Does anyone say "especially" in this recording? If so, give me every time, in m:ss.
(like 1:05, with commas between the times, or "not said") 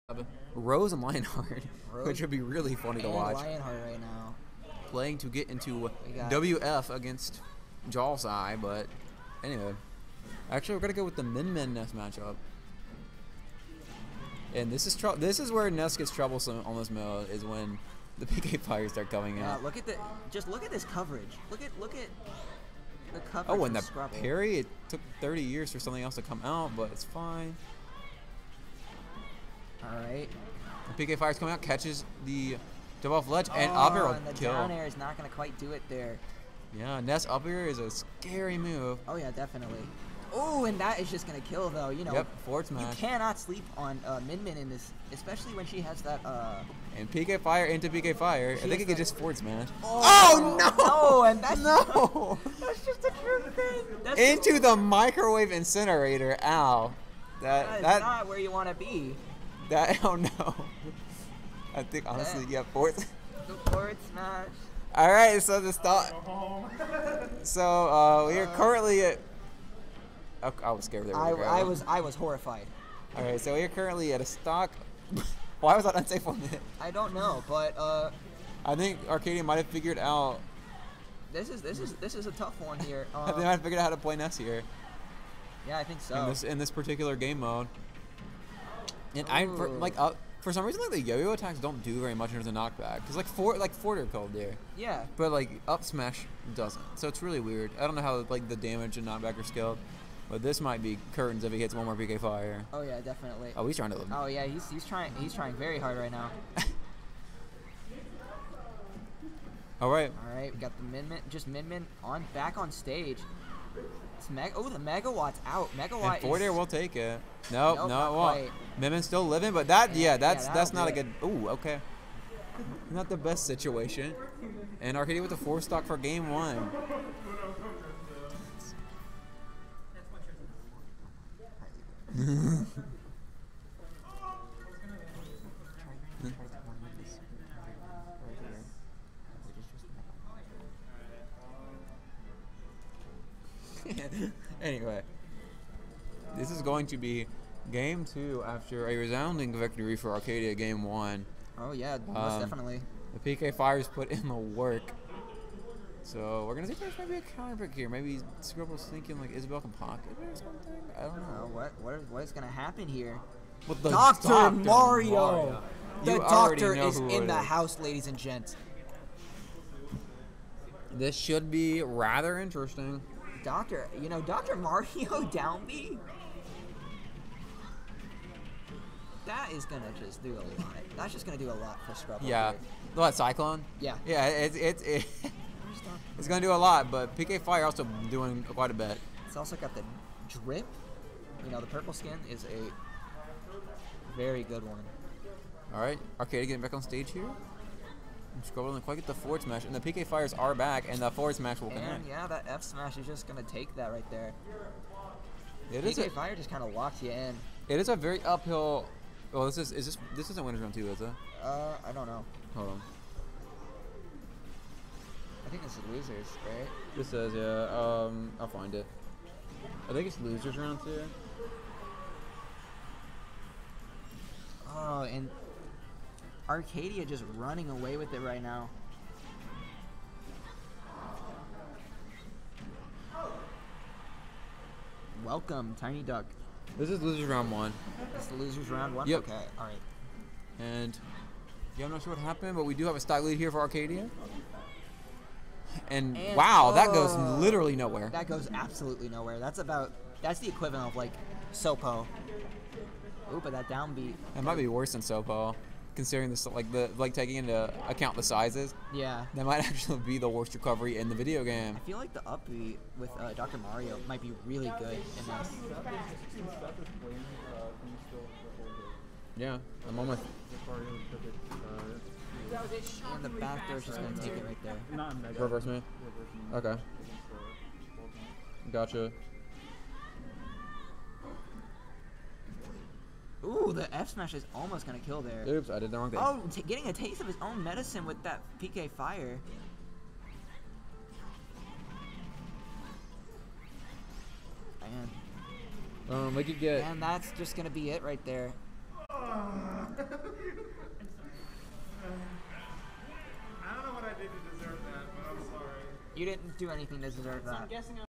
0:45.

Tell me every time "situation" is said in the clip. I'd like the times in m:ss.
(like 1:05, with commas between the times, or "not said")
2:03.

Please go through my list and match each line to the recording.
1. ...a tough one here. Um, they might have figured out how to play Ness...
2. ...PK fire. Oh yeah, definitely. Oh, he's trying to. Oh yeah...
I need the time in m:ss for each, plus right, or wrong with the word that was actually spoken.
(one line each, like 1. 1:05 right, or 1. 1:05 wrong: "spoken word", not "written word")
1. 1:22 right
2. 1:41 right.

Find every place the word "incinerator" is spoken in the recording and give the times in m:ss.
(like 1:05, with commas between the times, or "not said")
0:55.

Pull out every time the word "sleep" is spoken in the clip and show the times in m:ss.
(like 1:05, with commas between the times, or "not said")
0:43.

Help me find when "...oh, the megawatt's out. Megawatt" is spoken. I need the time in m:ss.
1:54.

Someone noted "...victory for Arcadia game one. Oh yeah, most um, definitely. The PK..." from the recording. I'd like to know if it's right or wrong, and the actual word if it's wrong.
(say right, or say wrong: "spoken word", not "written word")
right.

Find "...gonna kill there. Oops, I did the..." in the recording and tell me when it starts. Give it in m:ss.
4:44.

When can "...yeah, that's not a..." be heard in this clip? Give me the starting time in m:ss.
2:00.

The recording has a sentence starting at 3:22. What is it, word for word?
yeah, that F smash is just gonna take that right there.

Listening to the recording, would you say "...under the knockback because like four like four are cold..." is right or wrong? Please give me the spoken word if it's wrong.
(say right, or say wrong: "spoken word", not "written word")
right.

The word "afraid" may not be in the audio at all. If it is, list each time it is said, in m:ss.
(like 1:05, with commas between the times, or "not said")
not said.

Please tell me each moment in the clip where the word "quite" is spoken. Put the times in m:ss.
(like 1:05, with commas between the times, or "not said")
0:35, 3:08, 3:18.